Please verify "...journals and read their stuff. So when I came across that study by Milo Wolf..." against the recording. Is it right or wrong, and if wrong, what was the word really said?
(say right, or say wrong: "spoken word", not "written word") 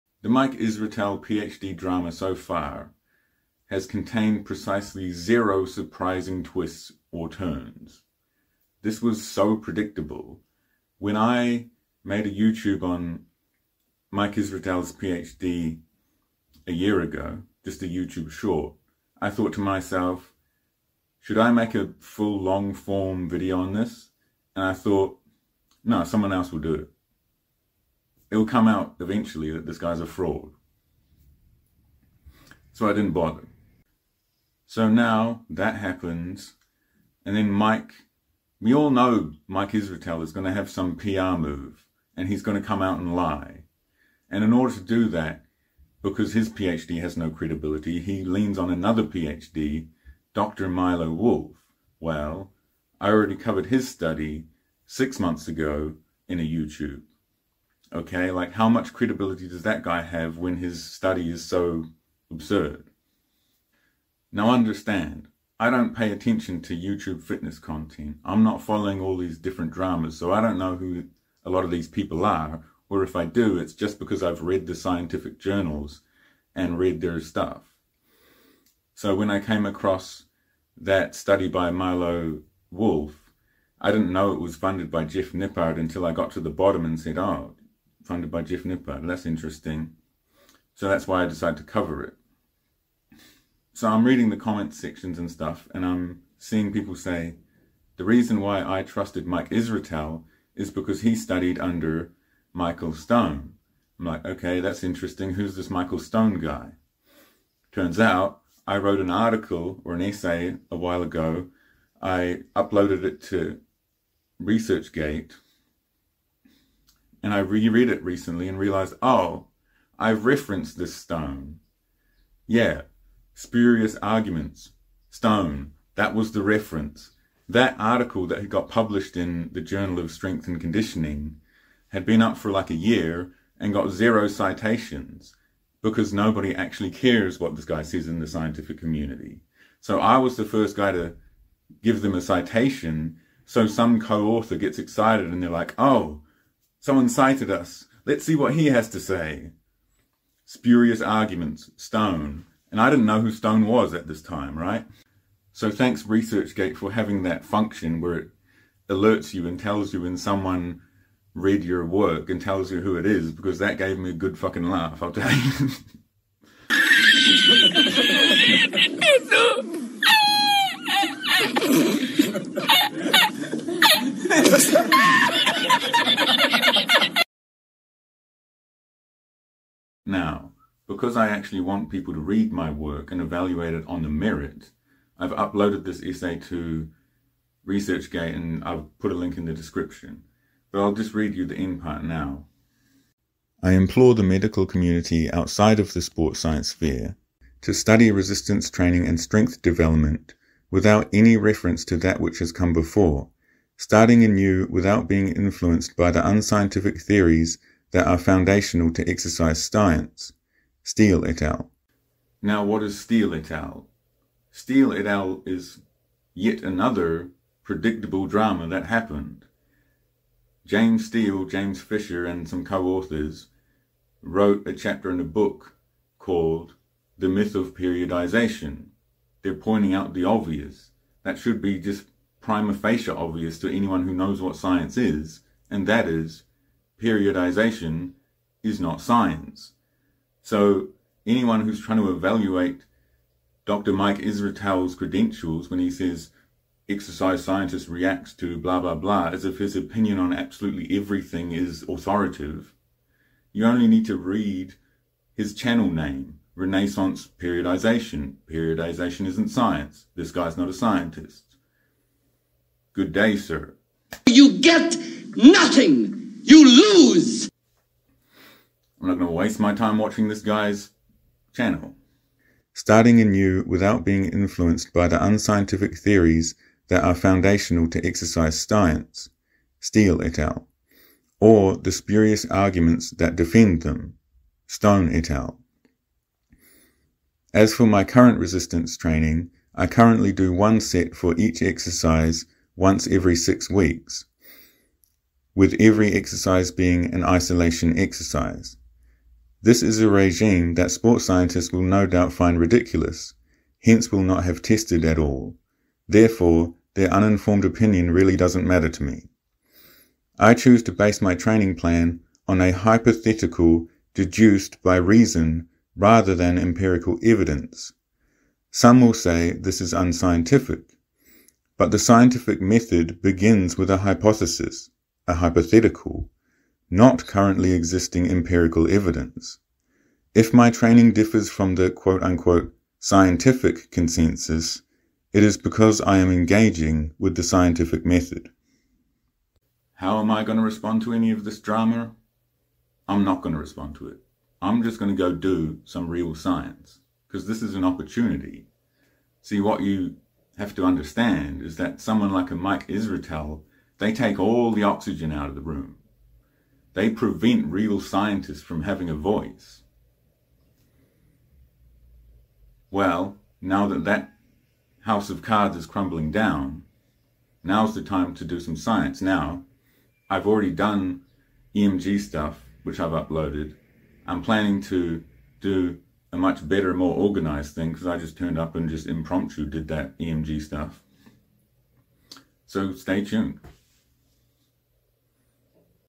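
right.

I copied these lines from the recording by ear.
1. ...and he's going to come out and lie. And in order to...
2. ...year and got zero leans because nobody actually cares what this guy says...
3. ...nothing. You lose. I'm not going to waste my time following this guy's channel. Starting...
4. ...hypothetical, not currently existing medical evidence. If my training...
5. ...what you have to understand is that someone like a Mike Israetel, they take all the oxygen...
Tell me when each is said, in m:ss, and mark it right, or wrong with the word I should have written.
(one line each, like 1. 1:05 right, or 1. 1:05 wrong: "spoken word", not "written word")
1. 0:42 right
2. 2:12 wrong: "citations", not "leans"
3. 4:25 wrong: "watching", not "following"
4. 5:25 wrong: "empirical", not "medical"
5. 5:49 right.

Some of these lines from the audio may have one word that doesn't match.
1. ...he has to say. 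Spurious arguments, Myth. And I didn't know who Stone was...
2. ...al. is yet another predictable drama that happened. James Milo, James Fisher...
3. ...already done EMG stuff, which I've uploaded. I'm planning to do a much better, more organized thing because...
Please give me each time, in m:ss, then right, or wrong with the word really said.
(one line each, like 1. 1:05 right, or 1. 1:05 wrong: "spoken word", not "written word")
1. 2:28 wrong: "Stone", not "Myth"
2. 3:35 wrong: "Steele", not "Milo"
3. 6:10 right.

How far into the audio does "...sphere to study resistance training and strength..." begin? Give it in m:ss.
3:16.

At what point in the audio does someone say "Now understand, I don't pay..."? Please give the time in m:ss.
1:04.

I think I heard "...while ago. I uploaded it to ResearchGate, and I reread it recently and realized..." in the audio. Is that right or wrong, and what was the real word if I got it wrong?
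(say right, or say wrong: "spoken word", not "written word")
right.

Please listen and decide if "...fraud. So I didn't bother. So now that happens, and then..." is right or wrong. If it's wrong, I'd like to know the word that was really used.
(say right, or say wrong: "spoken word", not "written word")
right.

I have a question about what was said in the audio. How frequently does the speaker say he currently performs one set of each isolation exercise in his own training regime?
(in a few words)
once every 6 weeks.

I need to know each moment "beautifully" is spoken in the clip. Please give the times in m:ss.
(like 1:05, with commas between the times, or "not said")
not said.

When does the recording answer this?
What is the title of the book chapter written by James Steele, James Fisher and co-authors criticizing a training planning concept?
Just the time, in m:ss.
3:47.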